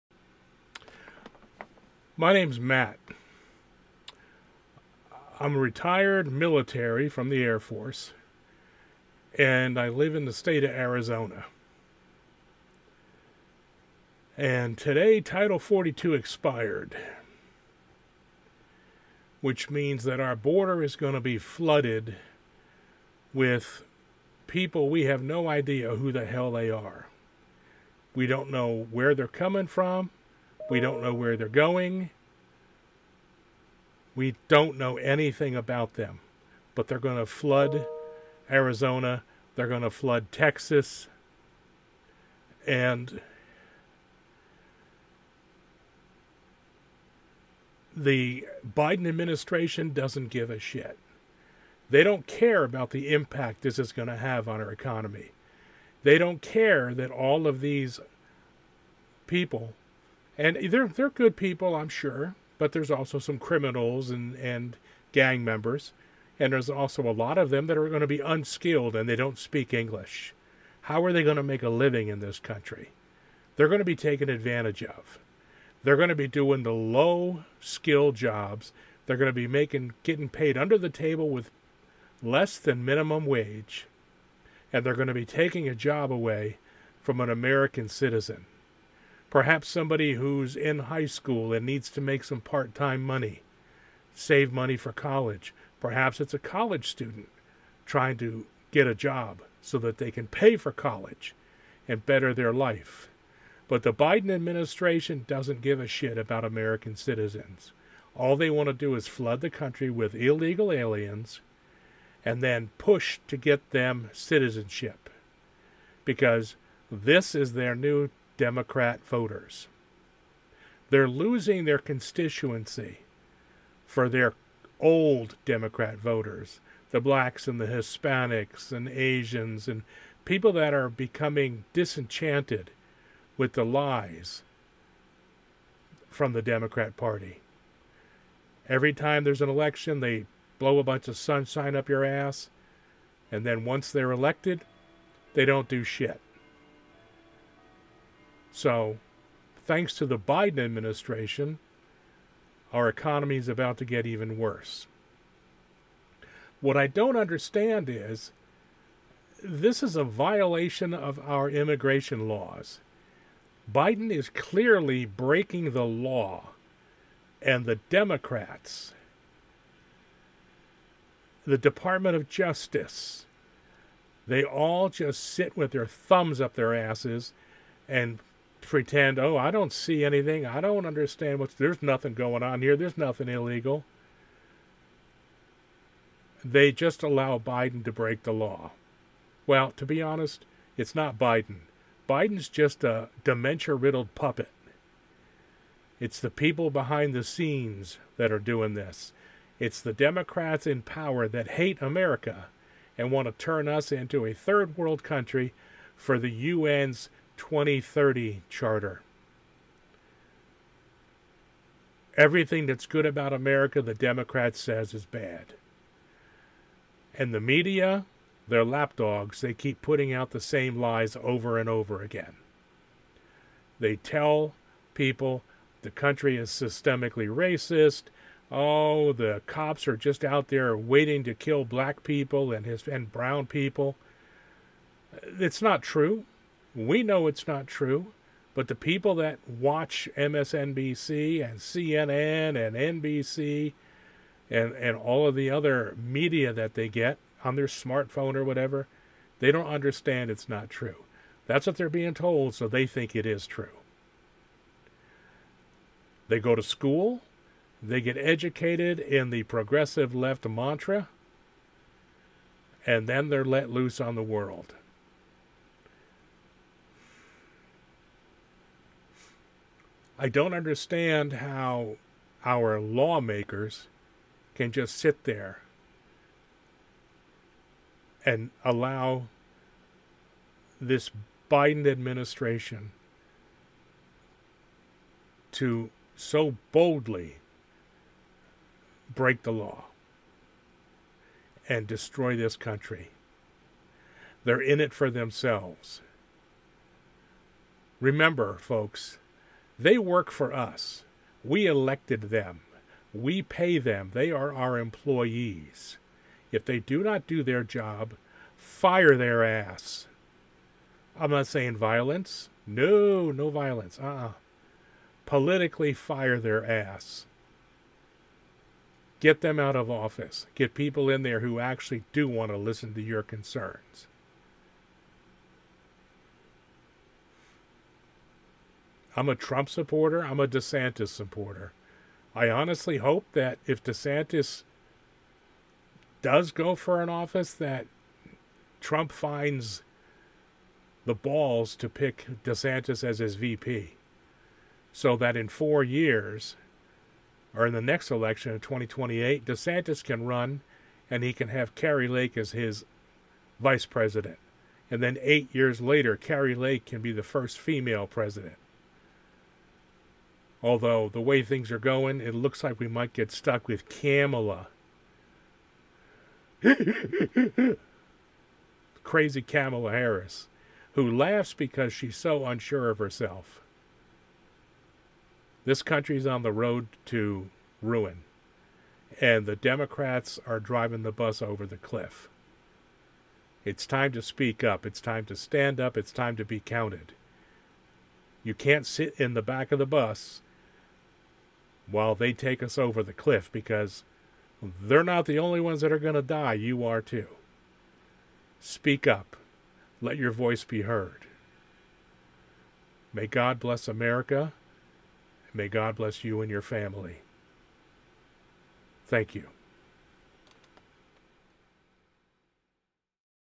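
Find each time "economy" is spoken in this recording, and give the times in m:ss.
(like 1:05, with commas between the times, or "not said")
0:54, 2:32.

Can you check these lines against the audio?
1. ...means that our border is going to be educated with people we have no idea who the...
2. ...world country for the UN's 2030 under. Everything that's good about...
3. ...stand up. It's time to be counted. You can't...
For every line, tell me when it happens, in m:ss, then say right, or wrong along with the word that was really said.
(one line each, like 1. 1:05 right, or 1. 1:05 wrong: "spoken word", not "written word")
1. 0:19 wrong: "flooded", not "educated"
2. 3:24 wrong: "charter", not "under"
3. 6:25 right.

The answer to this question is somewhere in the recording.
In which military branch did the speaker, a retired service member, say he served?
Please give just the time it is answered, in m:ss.
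0:07.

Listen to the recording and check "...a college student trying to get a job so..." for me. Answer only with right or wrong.
right.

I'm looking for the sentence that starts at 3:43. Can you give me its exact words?
They tell people the country is systemically racist.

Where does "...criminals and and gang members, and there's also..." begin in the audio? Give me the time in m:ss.
1:03.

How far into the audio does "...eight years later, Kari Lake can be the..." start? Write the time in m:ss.
5:55.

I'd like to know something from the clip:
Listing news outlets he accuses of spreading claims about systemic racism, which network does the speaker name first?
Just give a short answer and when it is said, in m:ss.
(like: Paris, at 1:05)
MSNBC, at 4:00.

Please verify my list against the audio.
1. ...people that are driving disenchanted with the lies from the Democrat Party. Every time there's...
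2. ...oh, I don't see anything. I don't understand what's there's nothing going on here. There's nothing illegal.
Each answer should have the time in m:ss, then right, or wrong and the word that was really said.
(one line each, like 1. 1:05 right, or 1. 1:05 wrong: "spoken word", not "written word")
1. 2:10 wrong: "becoming", not "driving"
2. 2:59 right.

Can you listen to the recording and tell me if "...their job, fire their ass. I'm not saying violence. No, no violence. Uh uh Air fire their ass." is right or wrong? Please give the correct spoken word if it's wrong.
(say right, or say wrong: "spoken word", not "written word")
wrong: "Politically", not "Air".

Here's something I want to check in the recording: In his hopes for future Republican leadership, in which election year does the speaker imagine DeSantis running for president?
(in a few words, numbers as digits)
2028.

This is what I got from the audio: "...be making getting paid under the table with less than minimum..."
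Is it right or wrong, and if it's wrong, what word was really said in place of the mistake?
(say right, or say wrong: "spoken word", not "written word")
right.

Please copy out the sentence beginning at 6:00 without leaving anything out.
Although the way things are going, it looks like we might get stuck with Kamala.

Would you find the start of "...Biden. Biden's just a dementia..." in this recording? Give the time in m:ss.
3:11.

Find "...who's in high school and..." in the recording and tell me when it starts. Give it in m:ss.
1:30.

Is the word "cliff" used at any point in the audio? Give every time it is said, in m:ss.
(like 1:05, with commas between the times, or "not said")
6:21, 6:33.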